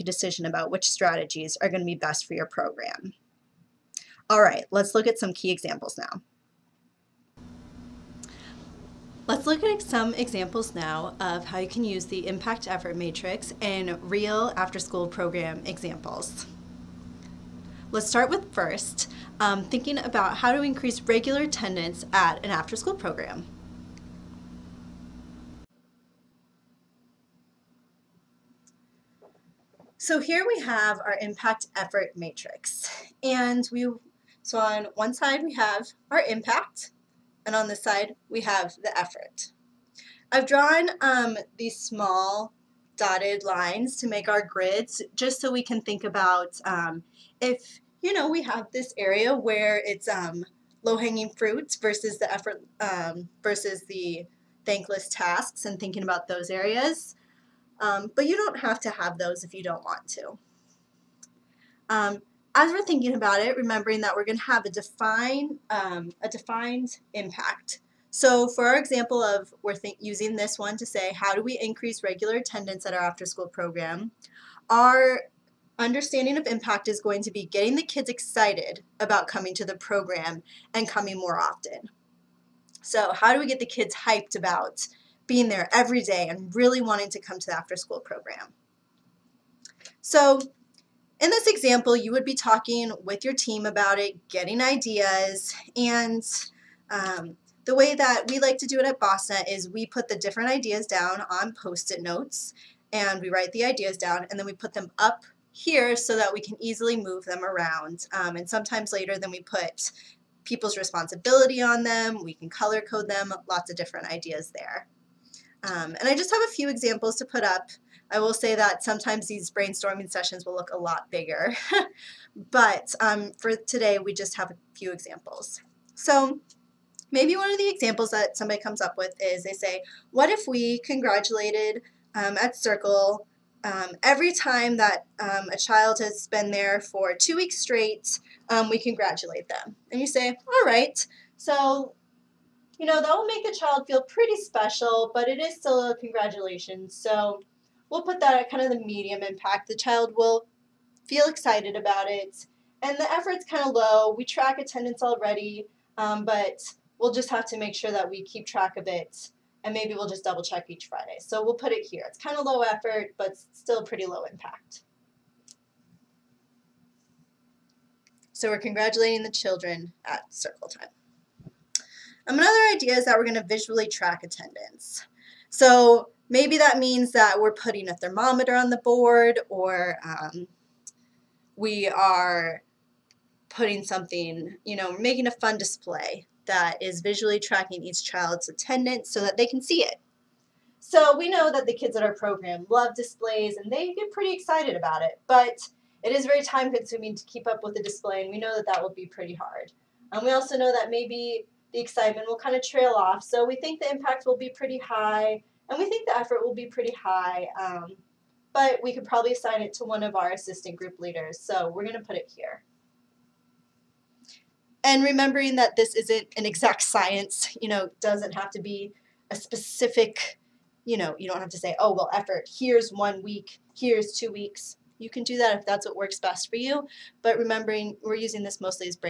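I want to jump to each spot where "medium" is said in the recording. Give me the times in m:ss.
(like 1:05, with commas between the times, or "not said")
2:28.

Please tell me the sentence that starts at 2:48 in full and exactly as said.
So we're congratulating the children at circle time.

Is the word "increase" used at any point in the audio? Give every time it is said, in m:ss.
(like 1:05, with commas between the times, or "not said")
0:20, 1:11.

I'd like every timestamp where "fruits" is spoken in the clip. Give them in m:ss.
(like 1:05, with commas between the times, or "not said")
0:51.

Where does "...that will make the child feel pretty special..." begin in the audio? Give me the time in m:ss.
2:22.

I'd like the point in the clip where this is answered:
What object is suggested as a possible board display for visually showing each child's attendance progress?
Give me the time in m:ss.
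2:57.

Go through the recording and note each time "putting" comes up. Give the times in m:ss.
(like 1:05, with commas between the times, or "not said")
2:57, 3:03.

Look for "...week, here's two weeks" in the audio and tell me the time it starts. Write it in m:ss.
3:43.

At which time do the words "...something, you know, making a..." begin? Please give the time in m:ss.
3:03.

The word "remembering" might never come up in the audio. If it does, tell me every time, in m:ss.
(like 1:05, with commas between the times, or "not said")
1:03, 3:35, 3:47.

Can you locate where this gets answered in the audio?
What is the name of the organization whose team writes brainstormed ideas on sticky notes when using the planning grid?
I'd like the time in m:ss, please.
1:38.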